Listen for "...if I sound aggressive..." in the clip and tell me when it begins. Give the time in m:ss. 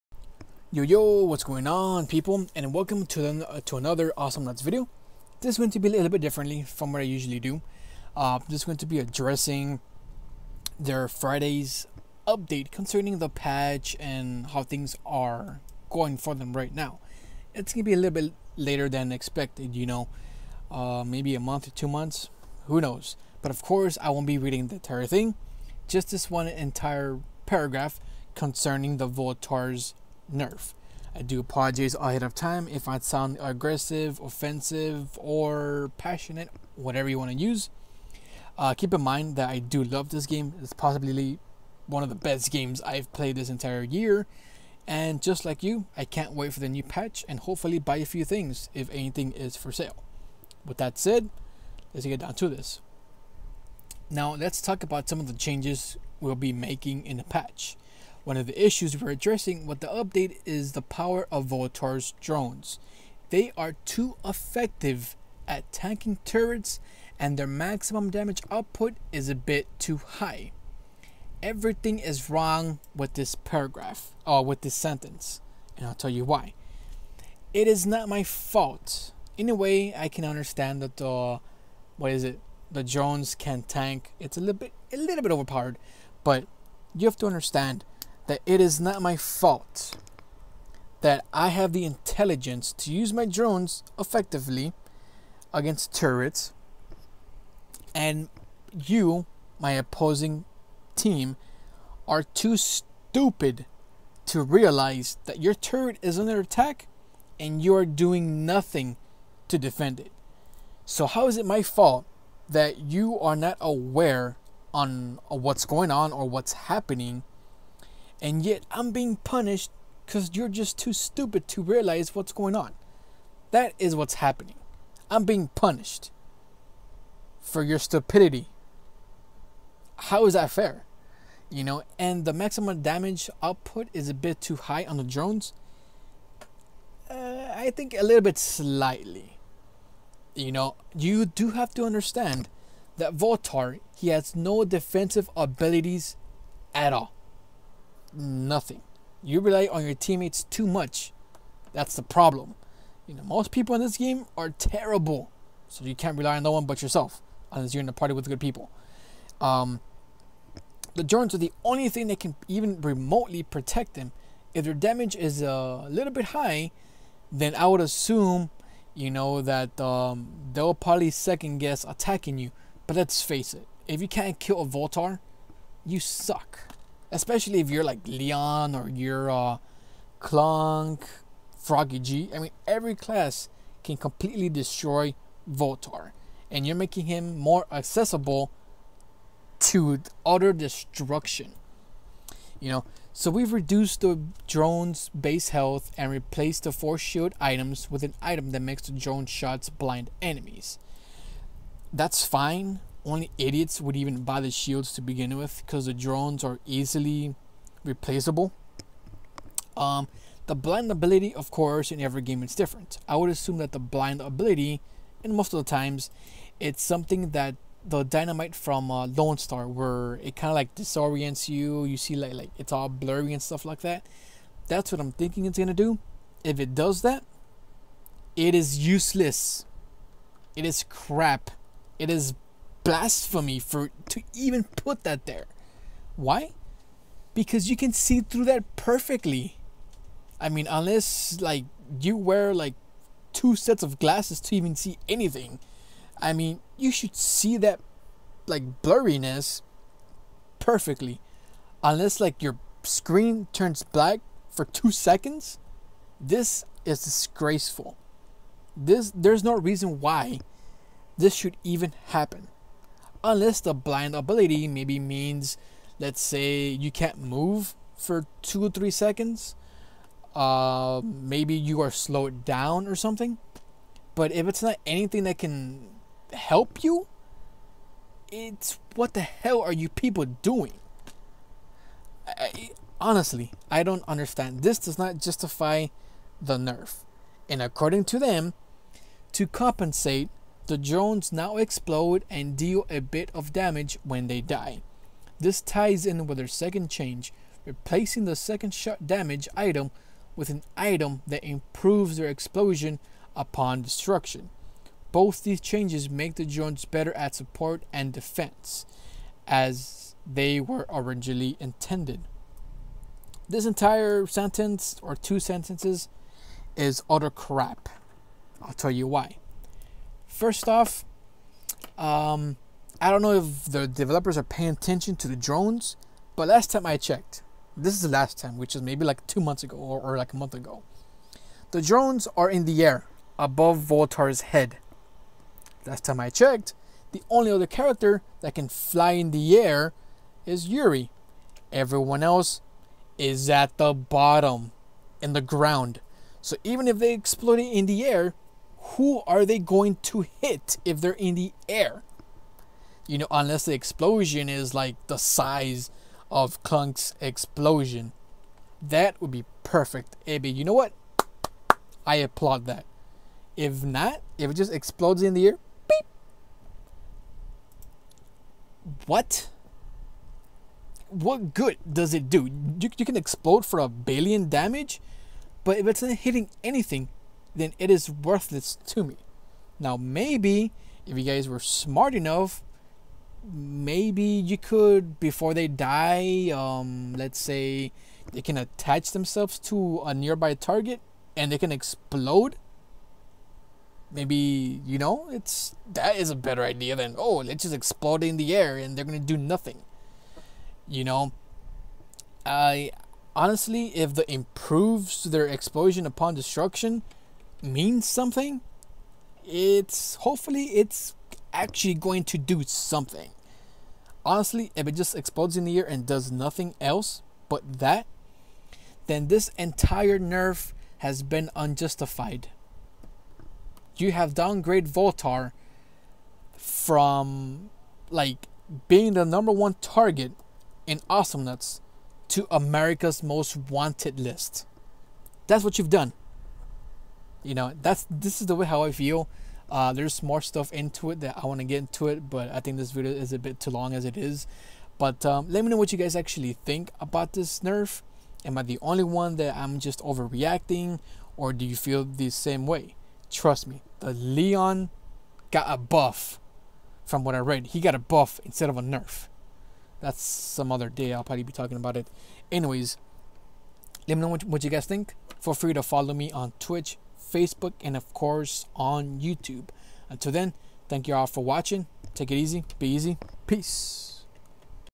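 0:32.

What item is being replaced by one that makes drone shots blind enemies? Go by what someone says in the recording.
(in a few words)
Force shield items.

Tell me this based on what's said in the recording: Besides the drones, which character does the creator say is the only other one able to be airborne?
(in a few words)
Yuri.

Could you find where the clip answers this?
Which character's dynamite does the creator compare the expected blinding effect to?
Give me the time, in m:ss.
3:39.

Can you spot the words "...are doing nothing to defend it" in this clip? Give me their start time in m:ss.
1:47.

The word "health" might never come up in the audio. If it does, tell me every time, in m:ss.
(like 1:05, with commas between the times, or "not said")
3:15.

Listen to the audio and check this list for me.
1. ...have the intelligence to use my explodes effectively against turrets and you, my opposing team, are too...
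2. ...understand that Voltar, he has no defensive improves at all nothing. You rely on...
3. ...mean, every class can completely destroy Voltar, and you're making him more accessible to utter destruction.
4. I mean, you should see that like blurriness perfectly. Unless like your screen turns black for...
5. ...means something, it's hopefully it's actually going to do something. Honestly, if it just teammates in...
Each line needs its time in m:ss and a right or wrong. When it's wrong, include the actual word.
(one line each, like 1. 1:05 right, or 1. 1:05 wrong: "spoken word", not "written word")
1. 1:31 wrong: "drones", not "explodes"
2. 2:21 wrong: "abilities", not "improves"
3. 3:02 right
4. 4:06 right
5. 6:47 wrong: "explodes", not "teammates".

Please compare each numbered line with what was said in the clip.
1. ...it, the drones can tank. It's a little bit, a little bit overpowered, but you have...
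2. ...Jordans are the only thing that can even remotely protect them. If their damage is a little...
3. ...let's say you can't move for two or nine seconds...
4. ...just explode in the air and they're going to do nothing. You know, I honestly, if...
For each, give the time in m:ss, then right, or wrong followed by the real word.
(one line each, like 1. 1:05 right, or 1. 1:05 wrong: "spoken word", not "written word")
1. 1:22 right
2. 2:41 right
3. 4:25 wrong: "three", not "nine"
4. 6:37 right.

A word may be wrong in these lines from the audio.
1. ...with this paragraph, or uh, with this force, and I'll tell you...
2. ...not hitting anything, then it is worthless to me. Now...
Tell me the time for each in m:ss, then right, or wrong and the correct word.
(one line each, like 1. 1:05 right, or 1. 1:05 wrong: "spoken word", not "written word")
1. 1:12 wrong: "sentence", not "force"
2. 6:16 right.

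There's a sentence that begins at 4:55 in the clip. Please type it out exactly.
This ties in with their second change, replacing the second shot damage item with an item that improves their explosion upon destruction.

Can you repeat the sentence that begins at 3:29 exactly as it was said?
Um, the blind ability, of course, in every game is different.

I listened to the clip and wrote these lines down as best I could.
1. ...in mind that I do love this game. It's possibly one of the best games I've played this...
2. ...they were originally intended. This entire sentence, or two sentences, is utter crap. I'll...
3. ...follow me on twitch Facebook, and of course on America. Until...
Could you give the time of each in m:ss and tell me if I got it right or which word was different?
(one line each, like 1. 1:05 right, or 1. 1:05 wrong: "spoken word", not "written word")
1. 0:38 right
2. 5:10 right
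3. 7:45 wrong: "YouTube", not "America".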